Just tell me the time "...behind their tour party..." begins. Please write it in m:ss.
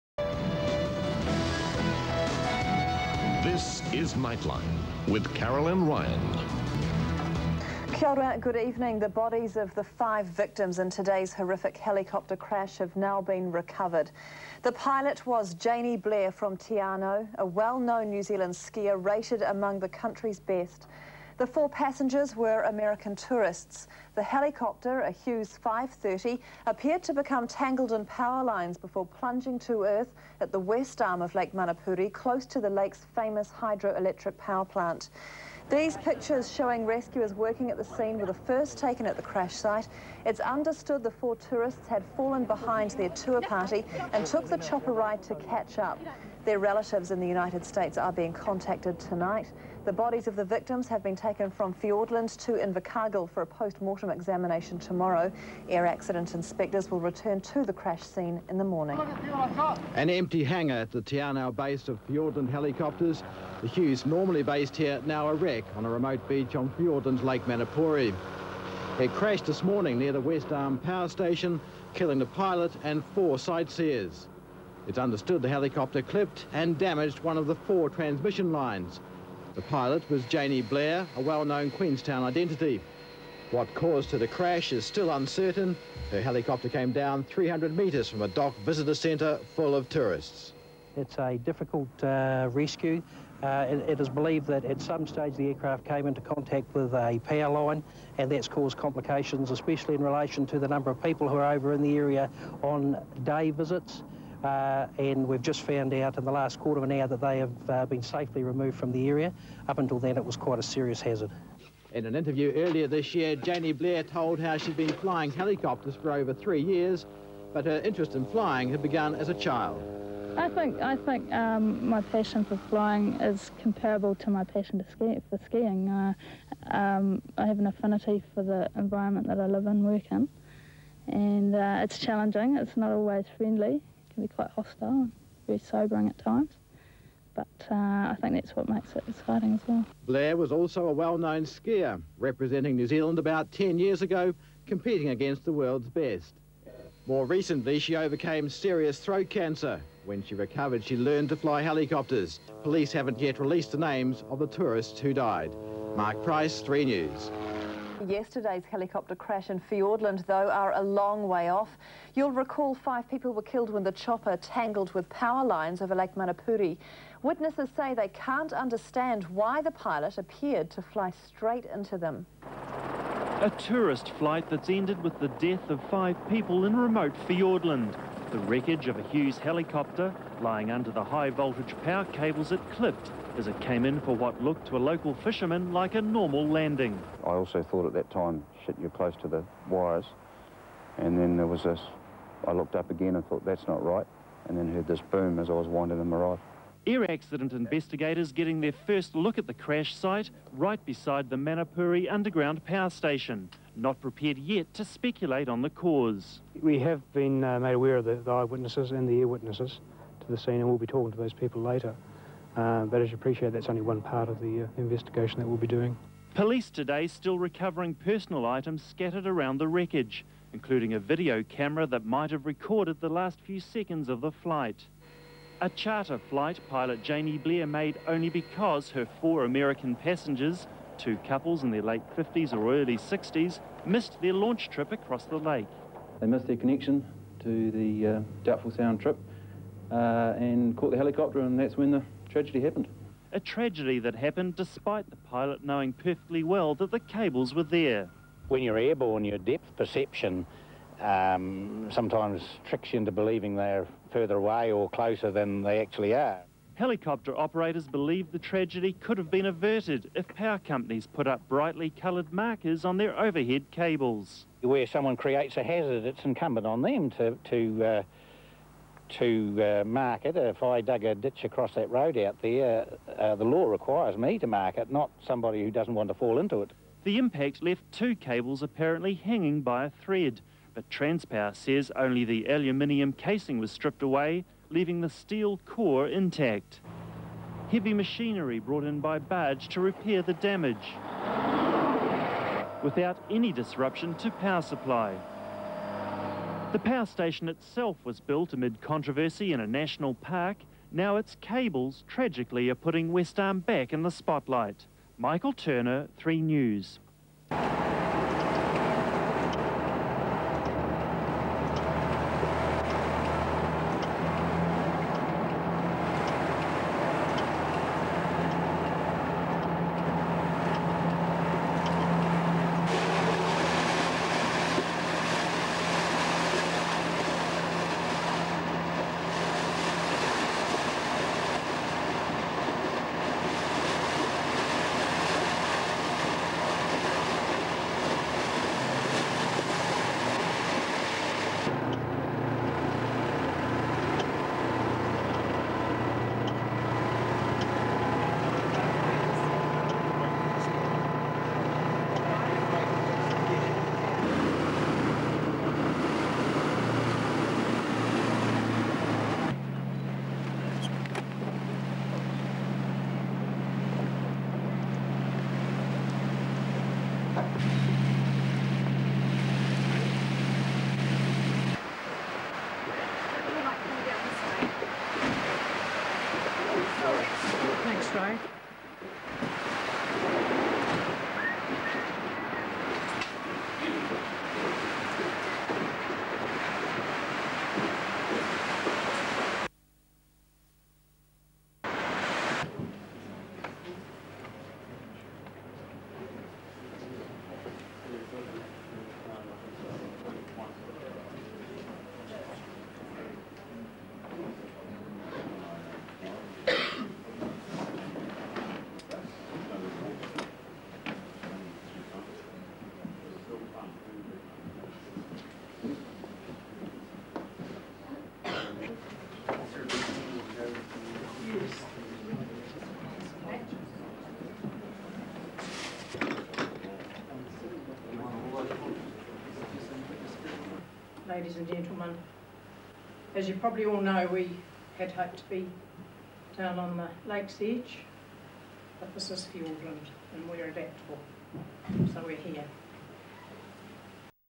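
0:42.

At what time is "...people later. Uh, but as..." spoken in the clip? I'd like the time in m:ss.
3:31.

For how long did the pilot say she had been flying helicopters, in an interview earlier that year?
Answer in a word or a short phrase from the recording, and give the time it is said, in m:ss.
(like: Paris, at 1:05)
over three years, at 1:56.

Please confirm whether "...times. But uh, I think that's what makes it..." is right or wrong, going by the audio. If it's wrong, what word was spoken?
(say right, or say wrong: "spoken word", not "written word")
right.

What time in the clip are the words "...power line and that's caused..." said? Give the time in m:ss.
1:37.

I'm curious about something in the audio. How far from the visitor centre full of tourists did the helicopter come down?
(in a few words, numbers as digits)
300 metres.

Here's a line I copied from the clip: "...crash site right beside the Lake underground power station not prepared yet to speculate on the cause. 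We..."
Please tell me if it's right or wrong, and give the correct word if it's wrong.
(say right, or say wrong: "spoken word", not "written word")
wrong: "Manapouri", not "Lake".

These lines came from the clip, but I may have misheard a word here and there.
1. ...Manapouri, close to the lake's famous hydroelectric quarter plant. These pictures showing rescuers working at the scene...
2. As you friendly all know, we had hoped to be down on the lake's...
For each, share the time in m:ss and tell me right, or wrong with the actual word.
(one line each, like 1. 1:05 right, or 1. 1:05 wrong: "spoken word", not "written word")
1. 0:31 wrong: "power", not "quarter"
2. 7:13 wrong: "probably", not "friendly".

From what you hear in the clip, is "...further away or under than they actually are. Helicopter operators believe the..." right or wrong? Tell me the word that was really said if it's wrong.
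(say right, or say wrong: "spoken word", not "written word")
wrong: "closer", not "under".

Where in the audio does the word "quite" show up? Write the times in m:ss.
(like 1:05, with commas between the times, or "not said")
1:50, 2:14.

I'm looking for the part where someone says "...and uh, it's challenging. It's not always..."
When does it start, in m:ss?
2:11.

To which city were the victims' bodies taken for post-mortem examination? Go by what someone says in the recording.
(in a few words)
Invercargill.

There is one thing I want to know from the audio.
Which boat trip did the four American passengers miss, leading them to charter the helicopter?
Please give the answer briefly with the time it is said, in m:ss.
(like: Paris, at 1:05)
Doubtful Sound, at 3:58.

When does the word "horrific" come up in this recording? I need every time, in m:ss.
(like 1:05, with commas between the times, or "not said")
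0:11.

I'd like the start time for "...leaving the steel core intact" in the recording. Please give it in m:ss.
4:44.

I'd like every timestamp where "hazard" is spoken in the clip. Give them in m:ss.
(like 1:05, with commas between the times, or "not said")
1:50, 4:25.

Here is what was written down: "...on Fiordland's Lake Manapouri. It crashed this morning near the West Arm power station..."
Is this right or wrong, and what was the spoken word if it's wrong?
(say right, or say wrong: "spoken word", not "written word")
right.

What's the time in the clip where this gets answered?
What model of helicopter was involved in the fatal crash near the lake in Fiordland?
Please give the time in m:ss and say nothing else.
0:25.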